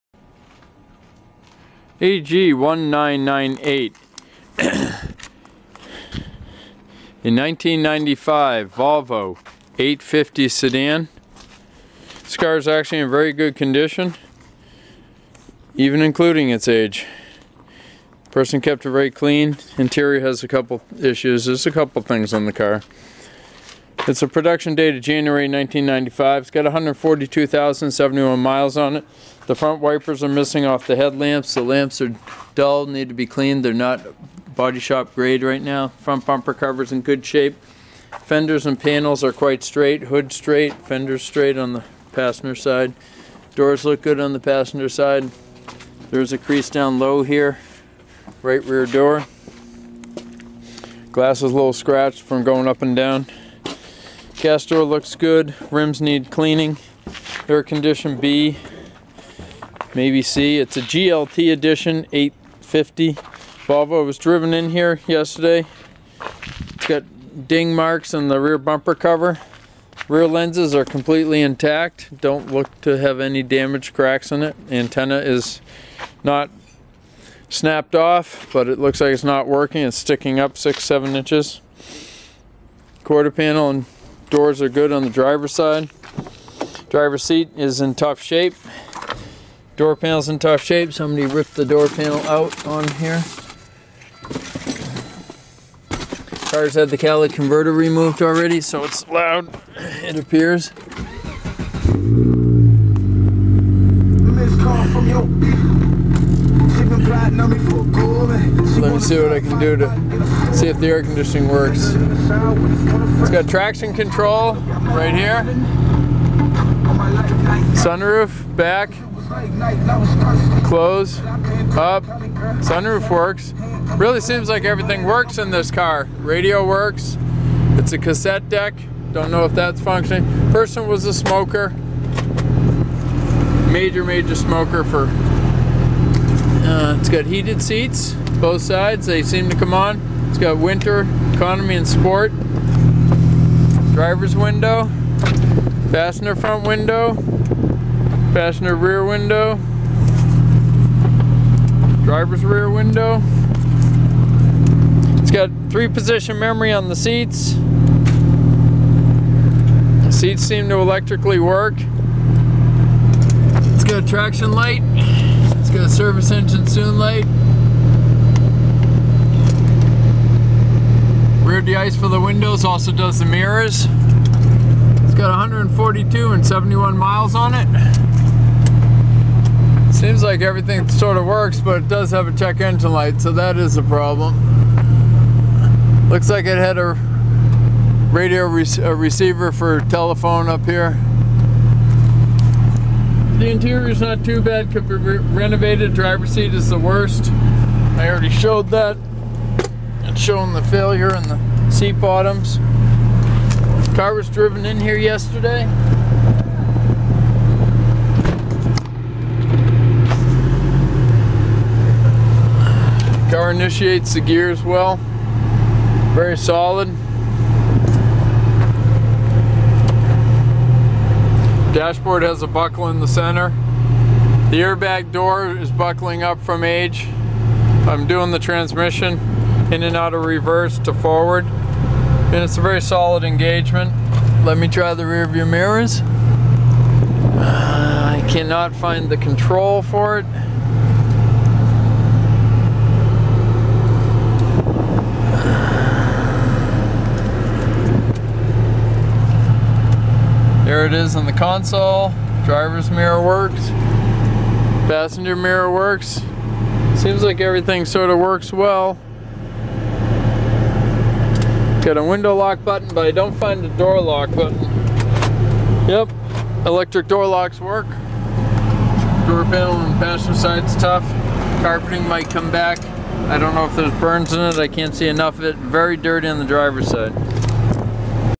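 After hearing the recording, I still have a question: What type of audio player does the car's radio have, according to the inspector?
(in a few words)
cassette deck.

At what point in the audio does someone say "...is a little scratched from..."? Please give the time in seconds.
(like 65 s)
51 s.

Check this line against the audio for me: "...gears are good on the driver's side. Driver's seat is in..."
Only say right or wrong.
wrong.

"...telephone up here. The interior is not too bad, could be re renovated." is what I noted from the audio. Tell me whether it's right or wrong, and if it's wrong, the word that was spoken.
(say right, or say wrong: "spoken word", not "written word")
right.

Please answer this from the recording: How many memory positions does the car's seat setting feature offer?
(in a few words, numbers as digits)
3.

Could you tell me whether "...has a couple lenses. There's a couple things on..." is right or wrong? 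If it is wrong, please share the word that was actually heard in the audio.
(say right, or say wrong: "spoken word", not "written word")
wrong: "issues", not "lenses".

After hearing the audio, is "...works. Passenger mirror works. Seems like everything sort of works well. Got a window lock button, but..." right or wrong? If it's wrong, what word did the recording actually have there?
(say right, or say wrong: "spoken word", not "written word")
right.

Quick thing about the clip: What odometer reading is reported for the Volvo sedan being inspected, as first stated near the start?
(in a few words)
142,071 miles.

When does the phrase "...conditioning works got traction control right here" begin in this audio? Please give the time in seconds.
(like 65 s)
111 s.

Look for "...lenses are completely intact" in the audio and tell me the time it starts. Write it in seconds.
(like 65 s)
70 s.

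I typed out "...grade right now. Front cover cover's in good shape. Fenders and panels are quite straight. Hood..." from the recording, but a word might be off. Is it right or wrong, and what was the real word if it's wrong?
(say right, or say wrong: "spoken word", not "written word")
wrong: "bumper", not "cover".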